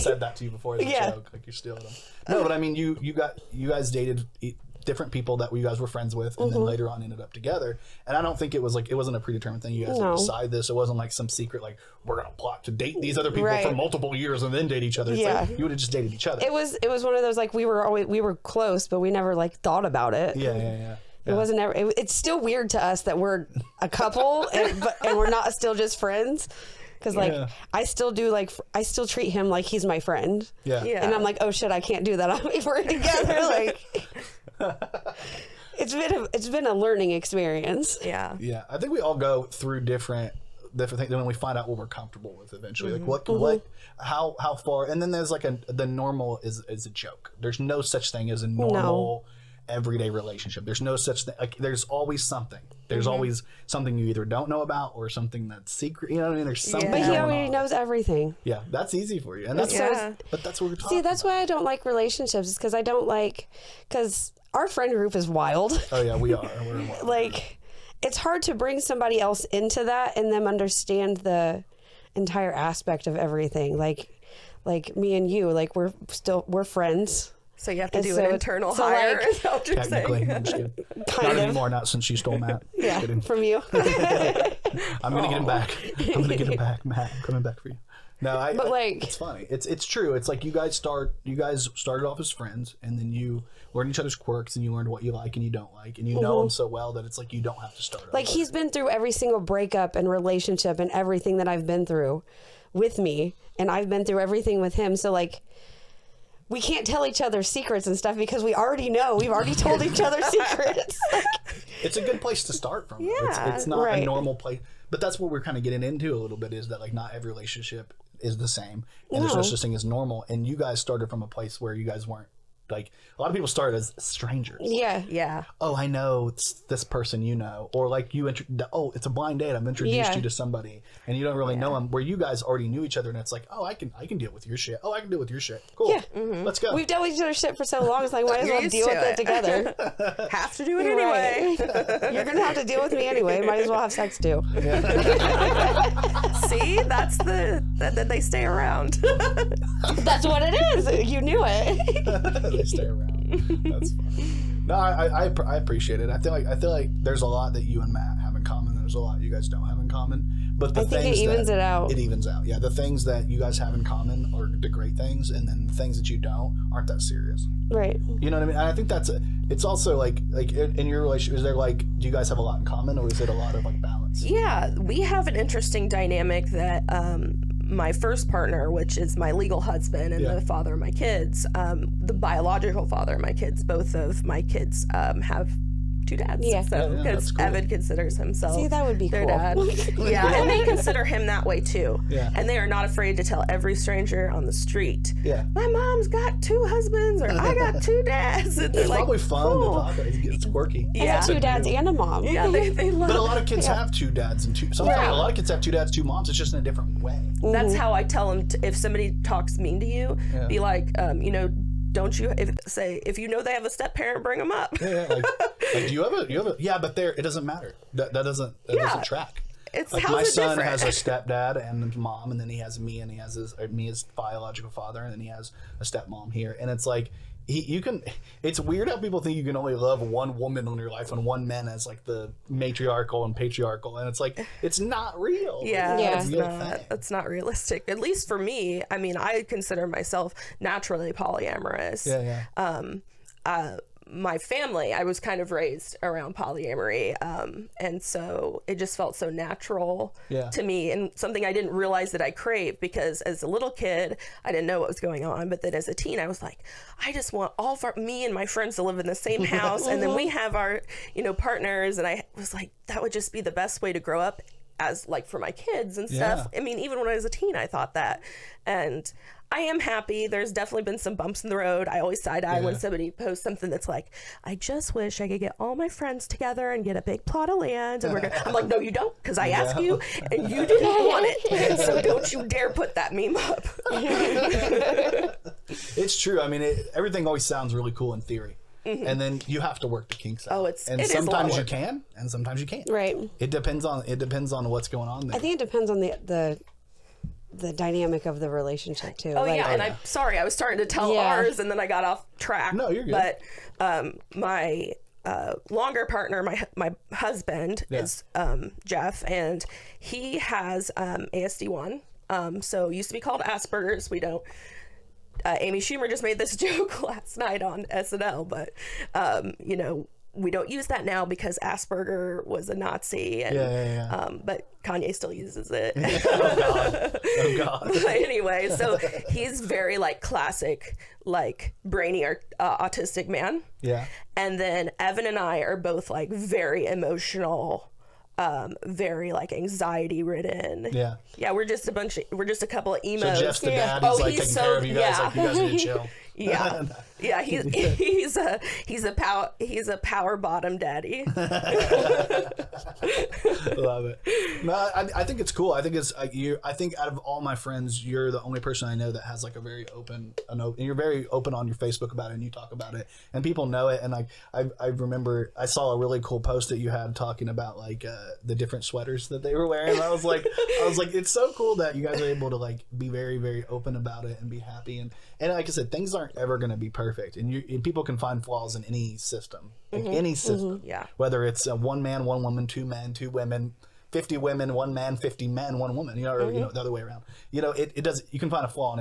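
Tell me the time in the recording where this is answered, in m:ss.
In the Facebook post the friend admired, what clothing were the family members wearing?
6:08.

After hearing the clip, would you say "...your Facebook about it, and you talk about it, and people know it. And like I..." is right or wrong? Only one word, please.
right.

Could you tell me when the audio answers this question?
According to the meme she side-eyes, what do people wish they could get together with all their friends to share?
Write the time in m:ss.
4:37.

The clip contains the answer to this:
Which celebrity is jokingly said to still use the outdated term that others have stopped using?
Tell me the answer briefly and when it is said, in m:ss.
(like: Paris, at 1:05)
Kanye, at 5:24.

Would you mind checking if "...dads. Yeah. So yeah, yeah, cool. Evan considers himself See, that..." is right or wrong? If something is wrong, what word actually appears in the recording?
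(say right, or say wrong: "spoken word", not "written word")
right.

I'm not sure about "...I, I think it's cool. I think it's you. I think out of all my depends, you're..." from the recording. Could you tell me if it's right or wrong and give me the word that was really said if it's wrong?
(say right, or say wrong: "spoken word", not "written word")
wrong: "friends", not "depends".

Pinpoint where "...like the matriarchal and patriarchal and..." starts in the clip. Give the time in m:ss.
3:51.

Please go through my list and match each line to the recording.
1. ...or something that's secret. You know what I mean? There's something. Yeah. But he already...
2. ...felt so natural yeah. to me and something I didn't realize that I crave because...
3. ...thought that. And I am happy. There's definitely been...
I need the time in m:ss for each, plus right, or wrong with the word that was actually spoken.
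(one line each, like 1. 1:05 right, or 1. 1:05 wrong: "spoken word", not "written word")
1. 0:54 right
2. 4:08 right
3. 4:27 right.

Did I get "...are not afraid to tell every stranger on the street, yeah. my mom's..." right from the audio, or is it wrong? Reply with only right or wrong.
right.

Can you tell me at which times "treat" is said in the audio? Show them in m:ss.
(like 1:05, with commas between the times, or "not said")
0:29.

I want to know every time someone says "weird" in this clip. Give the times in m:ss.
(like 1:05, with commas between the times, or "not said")
0:22, 3:48.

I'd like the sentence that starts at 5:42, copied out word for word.
Of, we're just a couple of emos.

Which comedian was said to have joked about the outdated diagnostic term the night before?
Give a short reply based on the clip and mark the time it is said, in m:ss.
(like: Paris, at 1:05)
Amy Schumer, at 5:15.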